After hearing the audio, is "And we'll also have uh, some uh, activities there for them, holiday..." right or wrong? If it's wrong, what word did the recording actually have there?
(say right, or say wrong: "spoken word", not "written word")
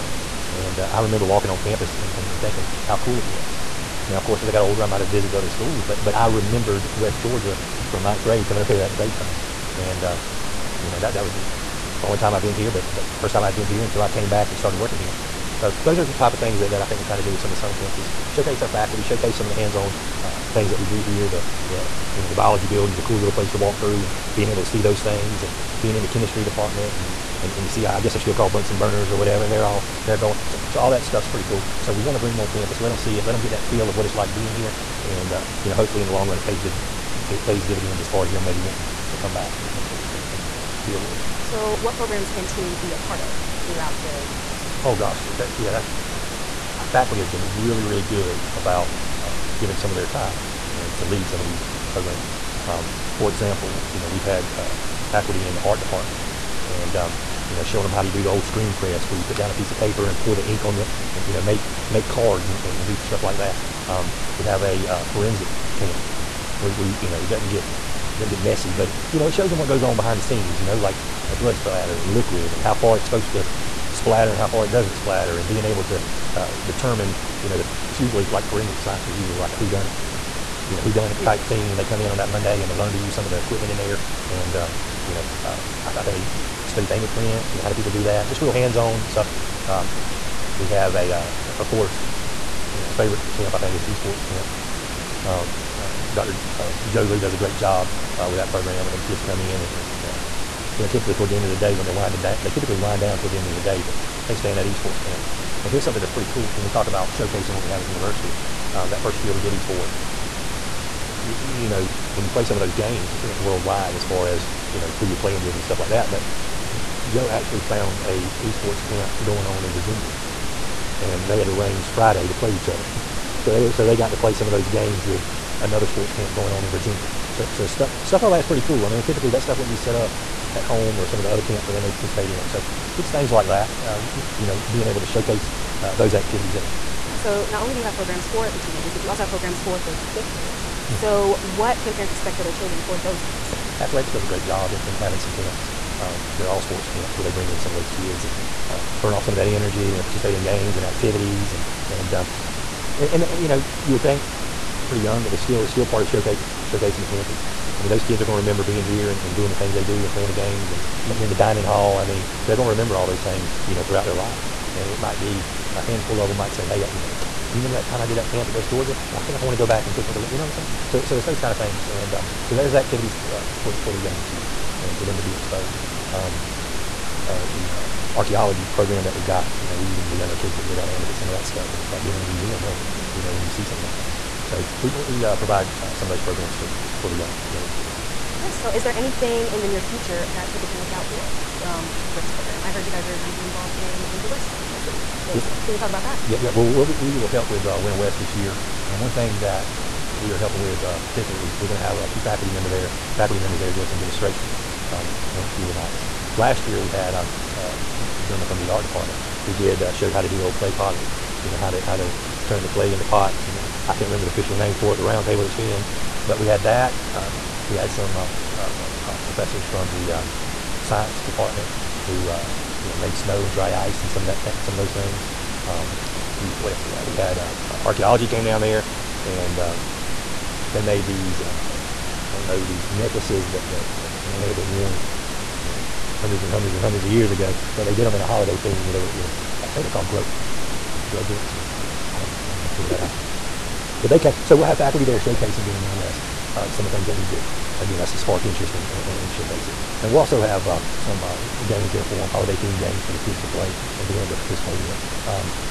wrong: "games", not "activities".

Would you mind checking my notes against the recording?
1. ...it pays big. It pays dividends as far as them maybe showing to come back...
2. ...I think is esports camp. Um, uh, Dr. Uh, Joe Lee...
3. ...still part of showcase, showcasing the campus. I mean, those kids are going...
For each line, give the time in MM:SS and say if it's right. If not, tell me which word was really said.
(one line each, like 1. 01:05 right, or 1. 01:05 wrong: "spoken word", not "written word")
1. 00:36 wrong: "wanting", not "showing"
2. 01:33 right
3. 02:35 right.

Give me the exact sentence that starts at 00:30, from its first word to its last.
So, so all that stuff's pretty cool.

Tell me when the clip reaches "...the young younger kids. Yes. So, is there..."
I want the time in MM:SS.
03:07.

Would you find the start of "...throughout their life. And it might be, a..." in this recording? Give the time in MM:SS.
02:43.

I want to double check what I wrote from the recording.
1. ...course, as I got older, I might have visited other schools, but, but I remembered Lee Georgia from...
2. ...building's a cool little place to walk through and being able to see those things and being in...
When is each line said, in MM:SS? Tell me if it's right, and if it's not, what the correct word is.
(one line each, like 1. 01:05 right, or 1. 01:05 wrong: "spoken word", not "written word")
1. 00:04 wrong: "West", not "Lee"
2. 00:22 right.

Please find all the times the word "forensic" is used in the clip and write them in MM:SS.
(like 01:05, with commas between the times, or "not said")
01:05, 01:18.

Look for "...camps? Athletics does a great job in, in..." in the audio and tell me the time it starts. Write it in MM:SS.
02:23.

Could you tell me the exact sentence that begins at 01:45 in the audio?
And here's something that's pretty cool when we talk about showcasing what we have at the university.